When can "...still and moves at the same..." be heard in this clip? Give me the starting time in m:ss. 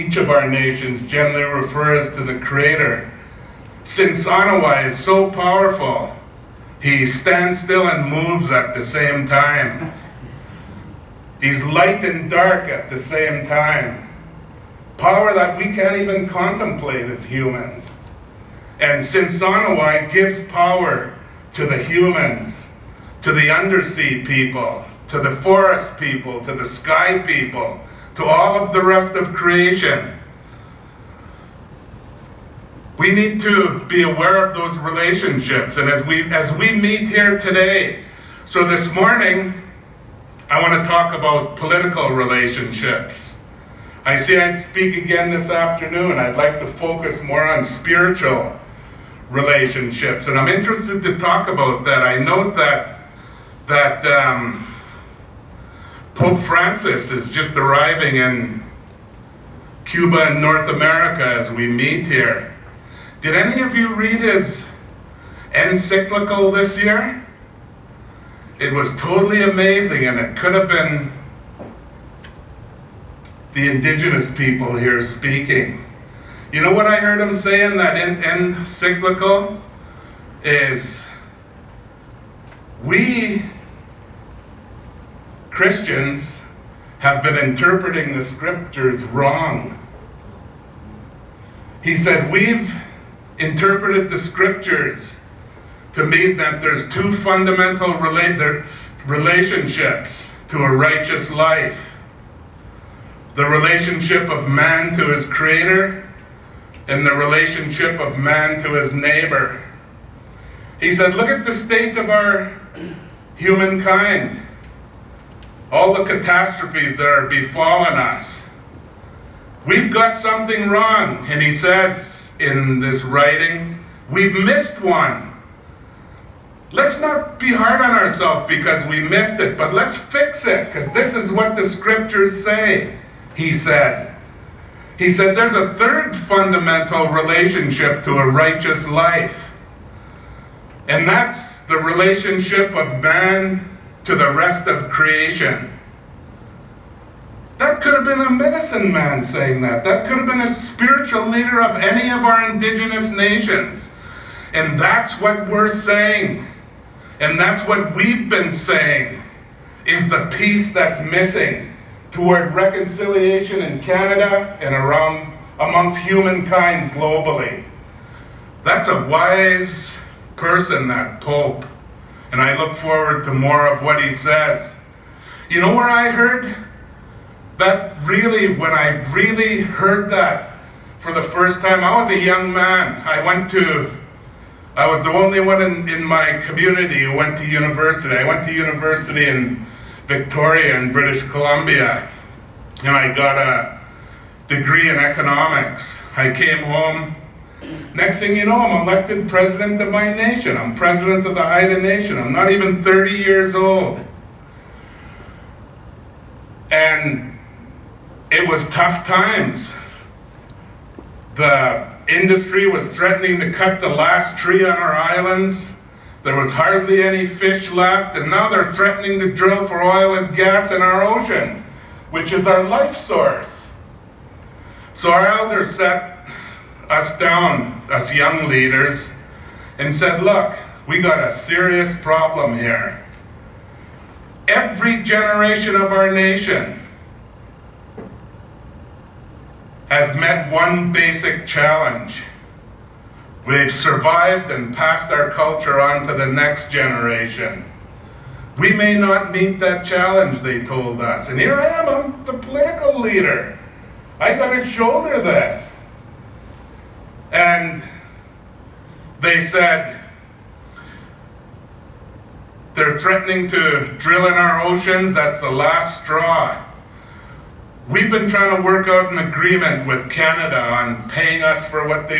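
0:07.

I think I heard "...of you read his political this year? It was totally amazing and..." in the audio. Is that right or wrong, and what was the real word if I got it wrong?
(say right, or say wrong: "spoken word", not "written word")
wrong: "encyclical", not "political".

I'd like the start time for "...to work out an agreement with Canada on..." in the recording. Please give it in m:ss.
4:28.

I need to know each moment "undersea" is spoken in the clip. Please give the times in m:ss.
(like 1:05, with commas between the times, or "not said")
0:23.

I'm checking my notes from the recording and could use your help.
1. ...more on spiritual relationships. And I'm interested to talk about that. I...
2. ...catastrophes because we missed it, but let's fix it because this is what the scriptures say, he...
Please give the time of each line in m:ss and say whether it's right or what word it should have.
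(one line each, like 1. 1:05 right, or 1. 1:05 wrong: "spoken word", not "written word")
1. 0:47 right
2. 2:07 wrong: "ourselves", not "catastrophes".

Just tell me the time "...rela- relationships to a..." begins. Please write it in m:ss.
1:37.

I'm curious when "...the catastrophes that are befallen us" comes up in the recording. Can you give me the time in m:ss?
1:55.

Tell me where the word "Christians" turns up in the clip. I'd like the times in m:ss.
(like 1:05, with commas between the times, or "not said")
1:25.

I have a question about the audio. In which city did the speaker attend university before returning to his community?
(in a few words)
Victoria.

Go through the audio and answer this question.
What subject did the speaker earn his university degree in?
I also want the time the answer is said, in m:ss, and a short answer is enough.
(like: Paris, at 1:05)
Economics, at 3:14.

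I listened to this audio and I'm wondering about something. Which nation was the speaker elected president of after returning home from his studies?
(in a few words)
Haida Nation.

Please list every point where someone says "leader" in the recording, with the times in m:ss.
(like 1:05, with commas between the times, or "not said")
2:31, 3:48, 4:12.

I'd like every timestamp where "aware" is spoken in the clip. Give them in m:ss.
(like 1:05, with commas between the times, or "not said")
0:34.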